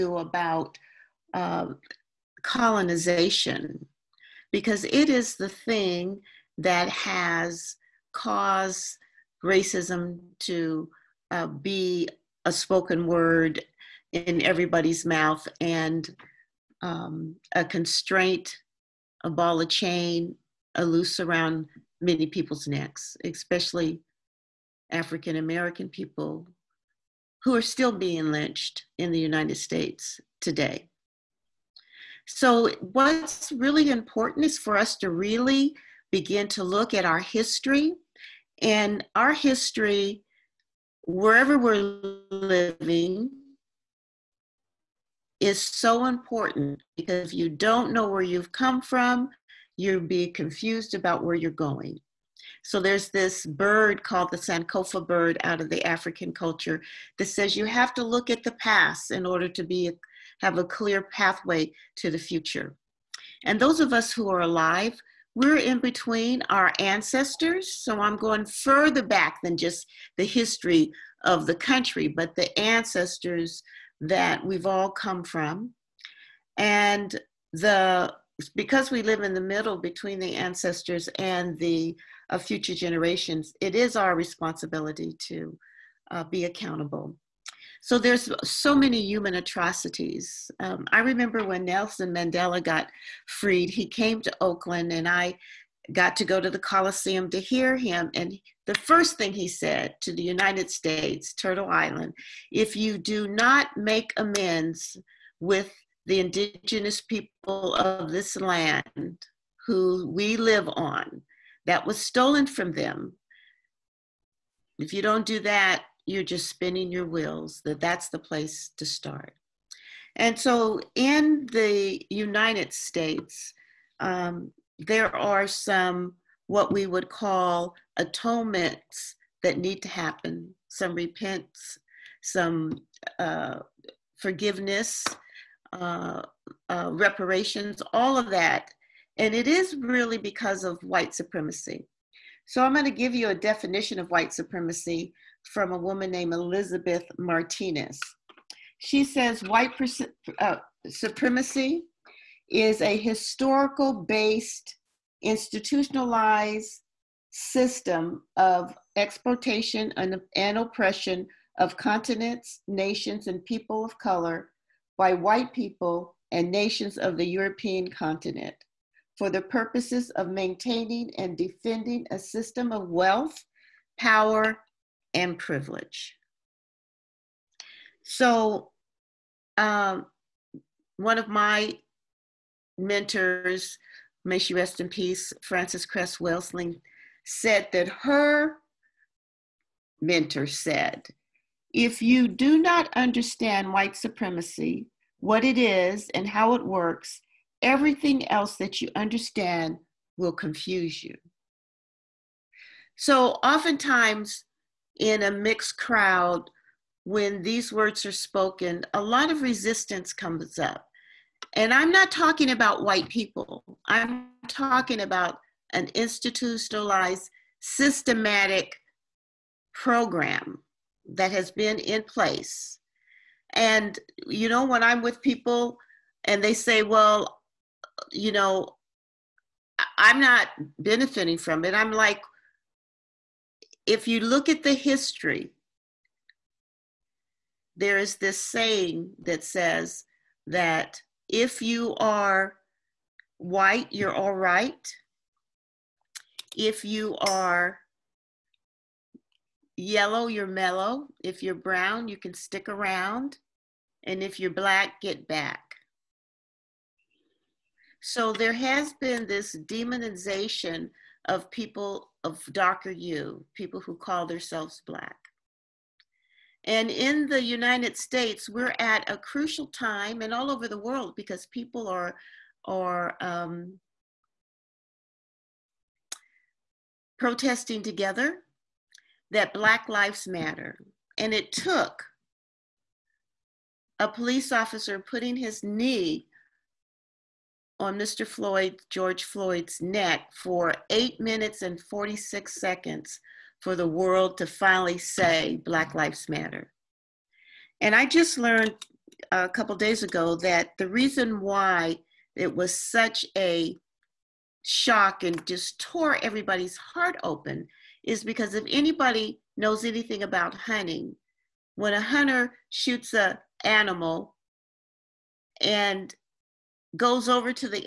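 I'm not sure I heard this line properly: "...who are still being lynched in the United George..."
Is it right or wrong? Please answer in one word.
wrong.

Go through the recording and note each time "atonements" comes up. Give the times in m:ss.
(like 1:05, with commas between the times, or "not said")
2:07.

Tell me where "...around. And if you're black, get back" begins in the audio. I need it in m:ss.
4:12.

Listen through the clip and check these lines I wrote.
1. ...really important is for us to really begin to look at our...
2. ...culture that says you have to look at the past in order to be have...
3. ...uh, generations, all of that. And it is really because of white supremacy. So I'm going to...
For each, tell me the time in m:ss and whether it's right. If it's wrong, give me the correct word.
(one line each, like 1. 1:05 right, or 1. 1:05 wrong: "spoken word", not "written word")
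1. 0:33 right
2. 0:56 right
3. 2:16 wrong: "reparations", not "generations".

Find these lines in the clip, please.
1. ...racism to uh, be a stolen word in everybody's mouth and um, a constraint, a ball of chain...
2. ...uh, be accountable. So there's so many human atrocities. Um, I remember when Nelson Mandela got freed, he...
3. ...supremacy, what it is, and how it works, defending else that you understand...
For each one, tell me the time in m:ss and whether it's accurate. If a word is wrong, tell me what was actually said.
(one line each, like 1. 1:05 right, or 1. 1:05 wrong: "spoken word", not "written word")
1. 0:09 wrong: "spoken", not "stolen"
2. 1:26 right
3. 3:13 wrong: "everything", not "defending".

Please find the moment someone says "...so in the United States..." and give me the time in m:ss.
2:00.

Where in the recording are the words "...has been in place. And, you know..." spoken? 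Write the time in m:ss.
3:41.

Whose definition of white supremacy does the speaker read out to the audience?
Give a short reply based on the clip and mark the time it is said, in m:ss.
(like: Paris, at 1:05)
Elizabeth Martinez, at 2:26.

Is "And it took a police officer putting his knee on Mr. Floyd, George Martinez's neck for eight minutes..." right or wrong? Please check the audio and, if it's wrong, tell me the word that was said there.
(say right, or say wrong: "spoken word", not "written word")
wrong: "Floyd", not "Martinez".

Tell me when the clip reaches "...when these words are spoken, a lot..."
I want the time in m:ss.
3:27.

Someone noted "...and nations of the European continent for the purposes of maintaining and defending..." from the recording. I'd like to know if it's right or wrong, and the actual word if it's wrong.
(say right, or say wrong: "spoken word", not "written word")
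right.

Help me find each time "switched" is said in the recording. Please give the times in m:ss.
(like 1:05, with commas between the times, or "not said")
not said.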